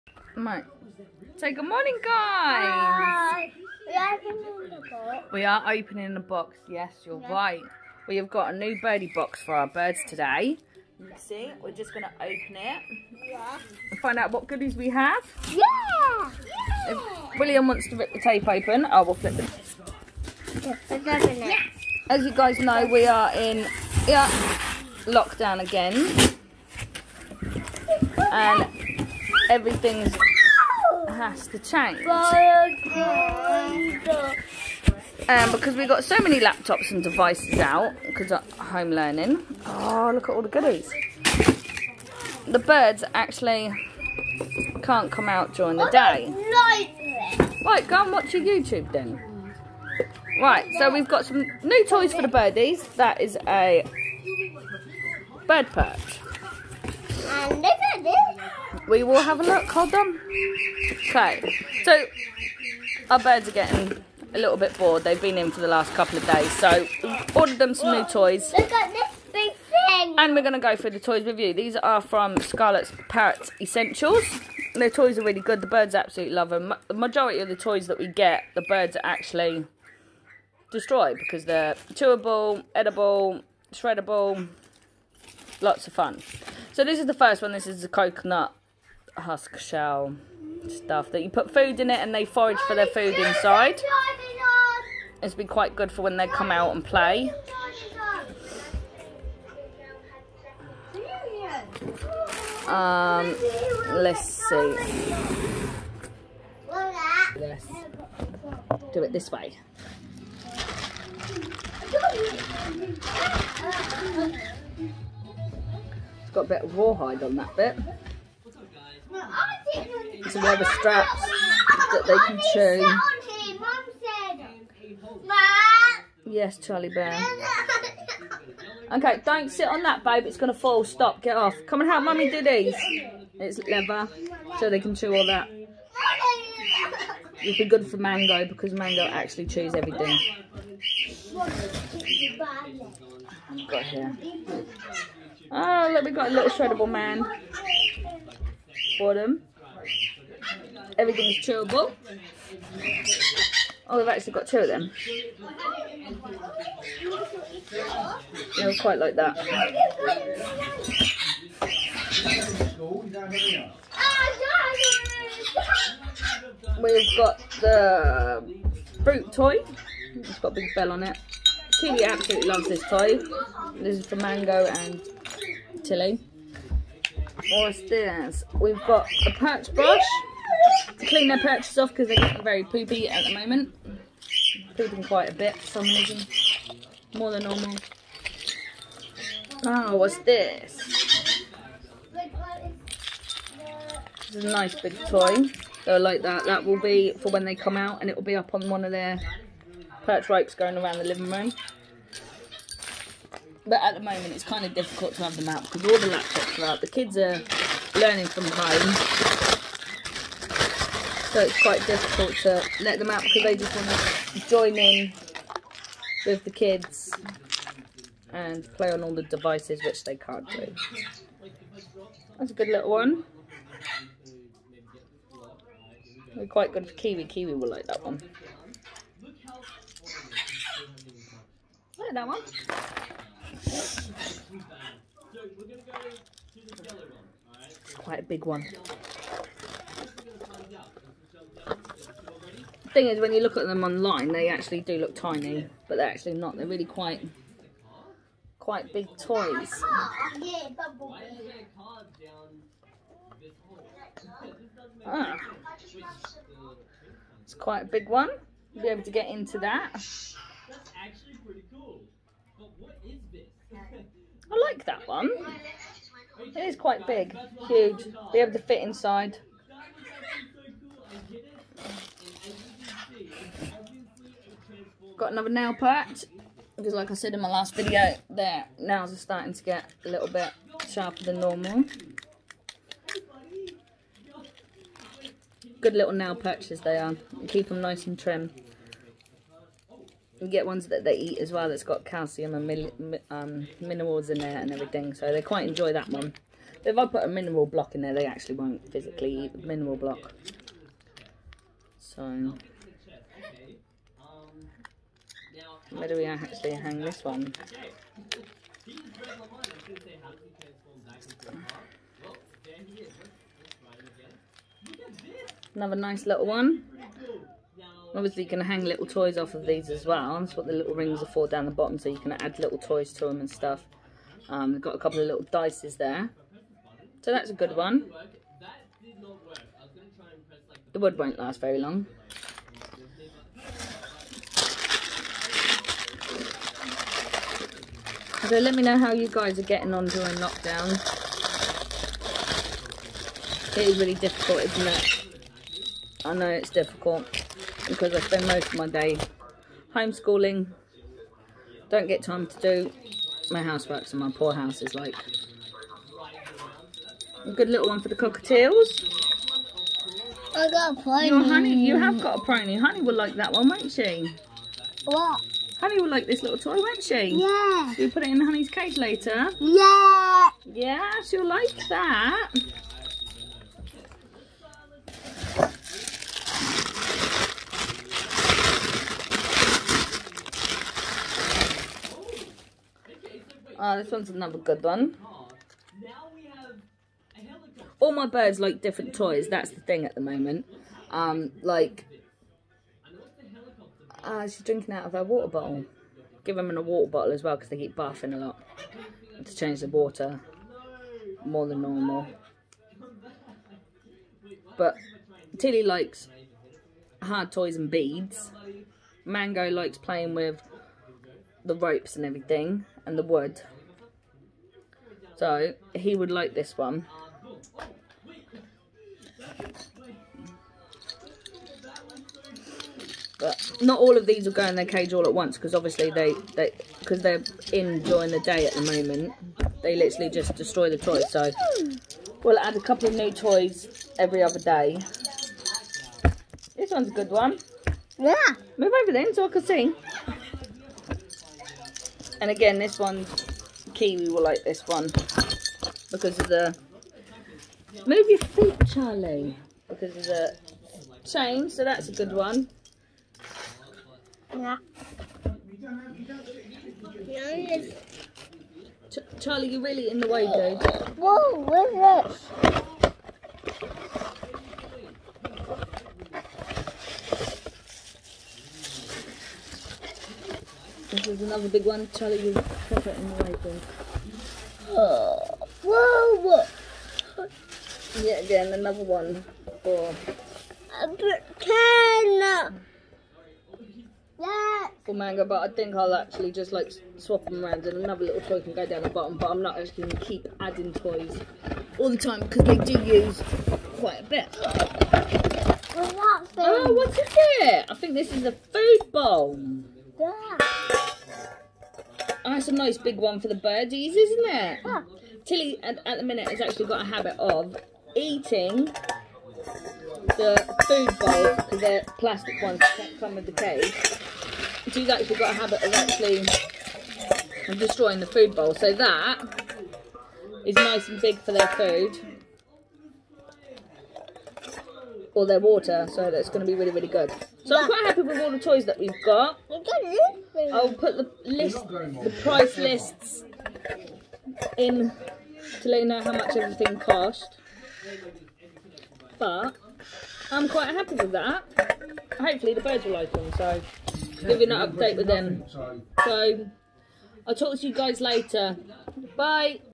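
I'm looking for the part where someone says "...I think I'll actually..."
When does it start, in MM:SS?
08:05.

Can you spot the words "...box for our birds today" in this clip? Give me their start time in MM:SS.
00:09.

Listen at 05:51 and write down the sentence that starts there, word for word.
Don't get time to do my housework, so my poor house is like.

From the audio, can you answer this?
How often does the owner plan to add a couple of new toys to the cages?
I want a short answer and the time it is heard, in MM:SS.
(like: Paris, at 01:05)
every other day, at 07:14.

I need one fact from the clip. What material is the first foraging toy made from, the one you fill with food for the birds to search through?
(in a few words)
coconut husk.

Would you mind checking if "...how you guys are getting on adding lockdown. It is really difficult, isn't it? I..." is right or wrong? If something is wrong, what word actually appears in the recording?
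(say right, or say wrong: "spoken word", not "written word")
wrong: "during", not "adding".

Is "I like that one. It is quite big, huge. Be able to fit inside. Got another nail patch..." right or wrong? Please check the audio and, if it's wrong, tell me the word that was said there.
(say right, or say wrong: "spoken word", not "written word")
right.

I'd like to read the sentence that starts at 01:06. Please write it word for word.
So we've ordered them some new toys.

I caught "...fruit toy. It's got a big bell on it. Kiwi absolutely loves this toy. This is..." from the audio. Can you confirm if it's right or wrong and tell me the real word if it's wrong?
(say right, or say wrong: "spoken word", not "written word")
right.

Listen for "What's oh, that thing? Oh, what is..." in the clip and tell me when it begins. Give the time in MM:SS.
08:14.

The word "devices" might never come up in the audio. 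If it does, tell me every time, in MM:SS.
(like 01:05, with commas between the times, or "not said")
00:37, 03:39.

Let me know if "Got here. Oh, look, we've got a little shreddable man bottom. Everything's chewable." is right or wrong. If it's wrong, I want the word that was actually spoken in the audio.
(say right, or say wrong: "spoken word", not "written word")
right.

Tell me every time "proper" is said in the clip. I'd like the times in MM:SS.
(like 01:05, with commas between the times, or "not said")
07:52.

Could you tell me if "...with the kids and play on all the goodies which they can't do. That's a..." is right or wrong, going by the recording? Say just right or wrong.
wrong.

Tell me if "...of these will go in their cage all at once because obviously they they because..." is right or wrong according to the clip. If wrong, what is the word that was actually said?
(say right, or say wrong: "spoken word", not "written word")
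right.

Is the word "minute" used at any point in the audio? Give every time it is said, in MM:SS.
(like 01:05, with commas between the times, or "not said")
08:26.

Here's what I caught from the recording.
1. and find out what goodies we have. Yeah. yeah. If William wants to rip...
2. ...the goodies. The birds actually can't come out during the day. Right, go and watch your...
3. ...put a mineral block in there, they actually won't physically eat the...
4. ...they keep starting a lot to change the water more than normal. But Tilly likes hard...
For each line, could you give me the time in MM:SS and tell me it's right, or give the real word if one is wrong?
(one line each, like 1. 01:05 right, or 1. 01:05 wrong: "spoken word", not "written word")
1. 00:13 right
2. 00:40 right
3. 04:57 right
4. 06:37 wrong: "barfing", not "starting".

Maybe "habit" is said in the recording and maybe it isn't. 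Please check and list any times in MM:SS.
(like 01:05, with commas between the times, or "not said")
08:27, 08:35.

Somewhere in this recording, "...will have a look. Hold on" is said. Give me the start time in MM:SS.
00:59.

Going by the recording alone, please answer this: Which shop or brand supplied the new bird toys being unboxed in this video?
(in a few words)
Scarlet's Parrot Essentials.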